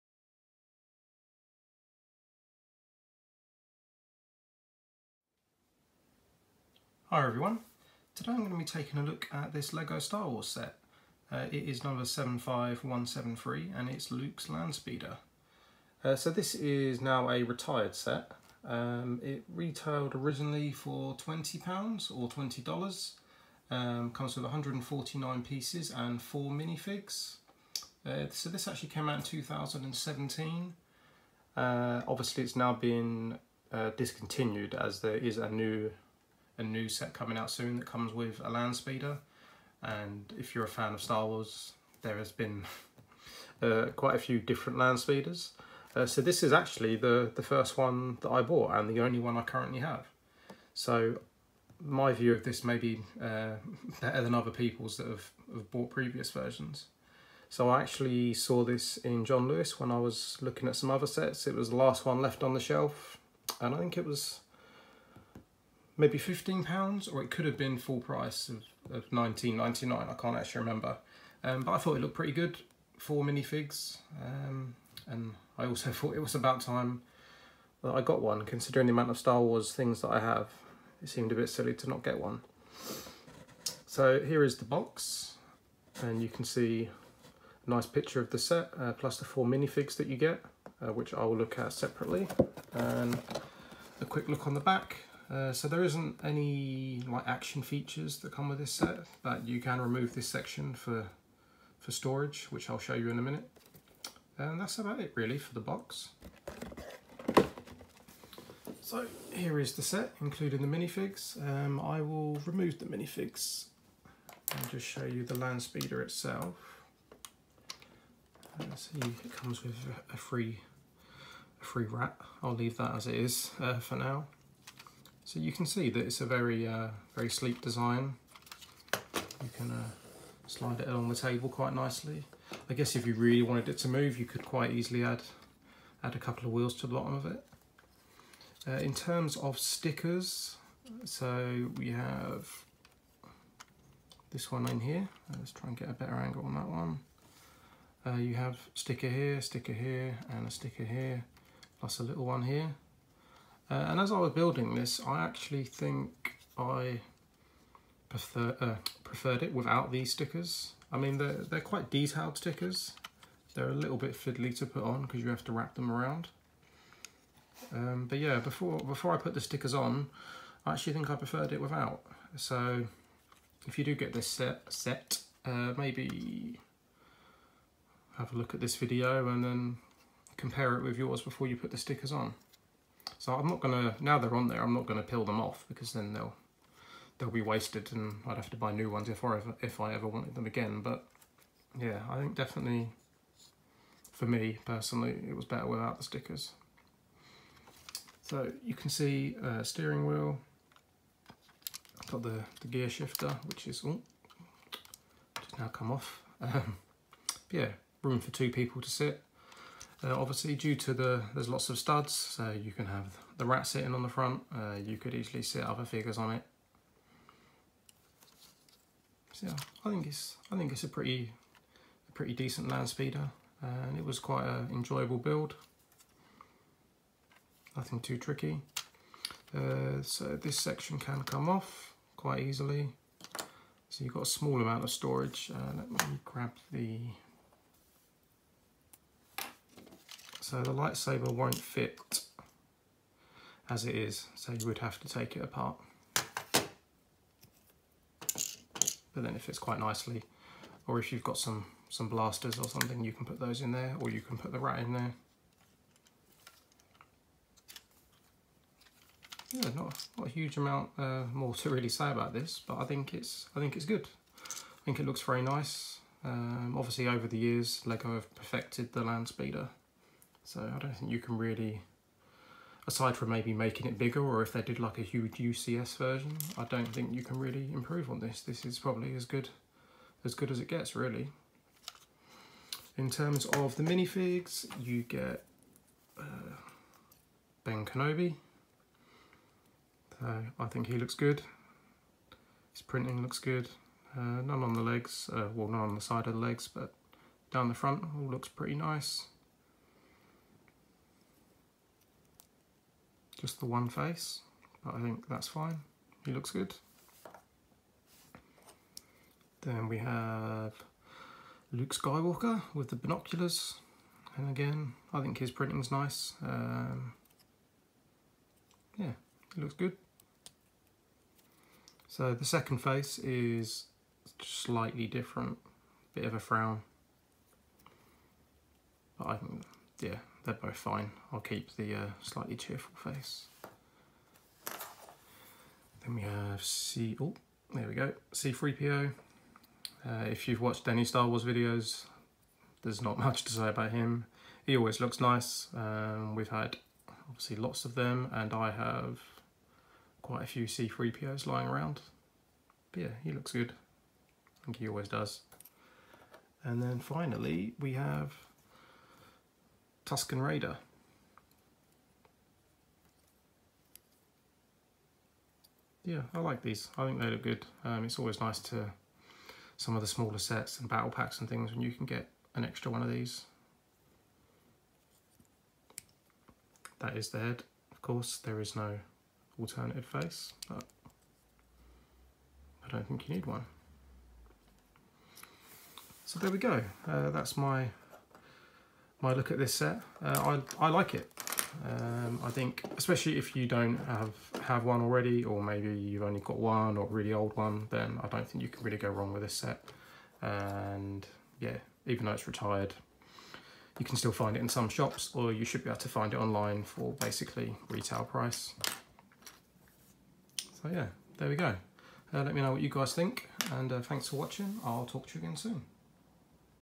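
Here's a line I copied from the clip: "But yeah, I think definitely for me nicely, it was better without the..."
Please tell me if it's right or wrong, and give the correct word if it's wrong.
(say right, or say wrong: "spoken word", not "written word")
wrong: "personally", not "nicely".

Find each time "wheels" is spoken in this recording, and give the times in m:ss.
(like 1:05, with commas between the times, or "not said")
2:16, 3:20.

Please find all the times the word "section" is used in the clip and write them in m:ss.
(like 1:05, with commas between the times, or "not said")
1:40, 3:50.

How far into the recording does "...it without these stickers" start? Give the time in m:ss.
2:39.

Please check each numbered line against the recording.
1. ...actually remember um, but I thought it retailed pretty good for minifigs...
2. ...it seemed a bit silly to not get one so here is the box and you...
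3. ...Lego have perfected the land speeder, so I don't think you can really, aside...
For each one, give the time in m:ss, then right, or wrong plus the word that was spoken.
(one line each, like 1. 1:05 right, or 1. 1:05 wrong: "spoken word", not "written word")
1. 1:10 wrong: "looked", not "retailed"
2. 1:21 right
3. 4:27 right.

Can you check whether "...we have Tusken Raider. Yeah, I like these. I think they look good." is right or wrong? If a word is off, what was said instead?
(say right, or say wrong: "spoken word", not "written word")
right.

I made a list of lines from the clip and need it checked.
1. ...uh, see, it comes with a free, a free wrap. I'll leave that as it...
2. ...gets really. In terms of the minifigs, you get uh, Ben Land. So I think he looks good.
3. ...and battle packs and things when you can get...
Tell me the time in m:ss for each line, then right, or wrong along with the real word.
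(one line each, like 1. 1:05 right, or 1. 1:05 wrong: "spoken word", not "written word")
1. 1:58 right
2. 4:40 wrong: "Kenobi", not "Land"
3. 6:10 right.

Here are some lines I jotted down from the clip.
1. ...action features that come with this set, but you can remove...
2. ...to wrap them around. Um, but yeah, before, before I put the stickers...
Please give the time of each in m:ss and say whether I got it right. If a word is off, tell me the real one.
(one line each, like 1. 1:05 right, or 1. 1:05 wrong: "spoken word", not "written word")
1. 1:37 right
2. 2:45 right.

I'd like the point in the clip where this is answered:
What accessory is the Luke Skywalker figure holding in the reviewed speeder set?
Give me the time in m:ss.
5:12.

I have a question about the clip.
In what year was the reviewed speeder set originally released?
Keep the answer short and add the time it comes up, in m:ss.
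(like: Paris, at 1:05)
2017, at 0:29.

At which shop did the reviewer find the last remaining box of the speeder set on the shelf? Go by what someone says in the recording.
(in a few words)
John Lewis.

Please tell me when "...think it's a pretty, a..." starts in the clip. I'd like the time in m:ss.
3:40.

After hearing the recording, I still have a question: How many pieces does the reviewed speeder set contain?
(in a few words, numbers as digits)
149.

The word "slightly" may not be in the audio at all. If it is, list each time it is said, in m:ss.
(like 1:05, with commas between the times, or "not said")
5:24, 5:32.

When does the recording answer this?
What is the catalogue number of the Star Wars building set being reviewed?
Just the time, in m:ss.
0:12.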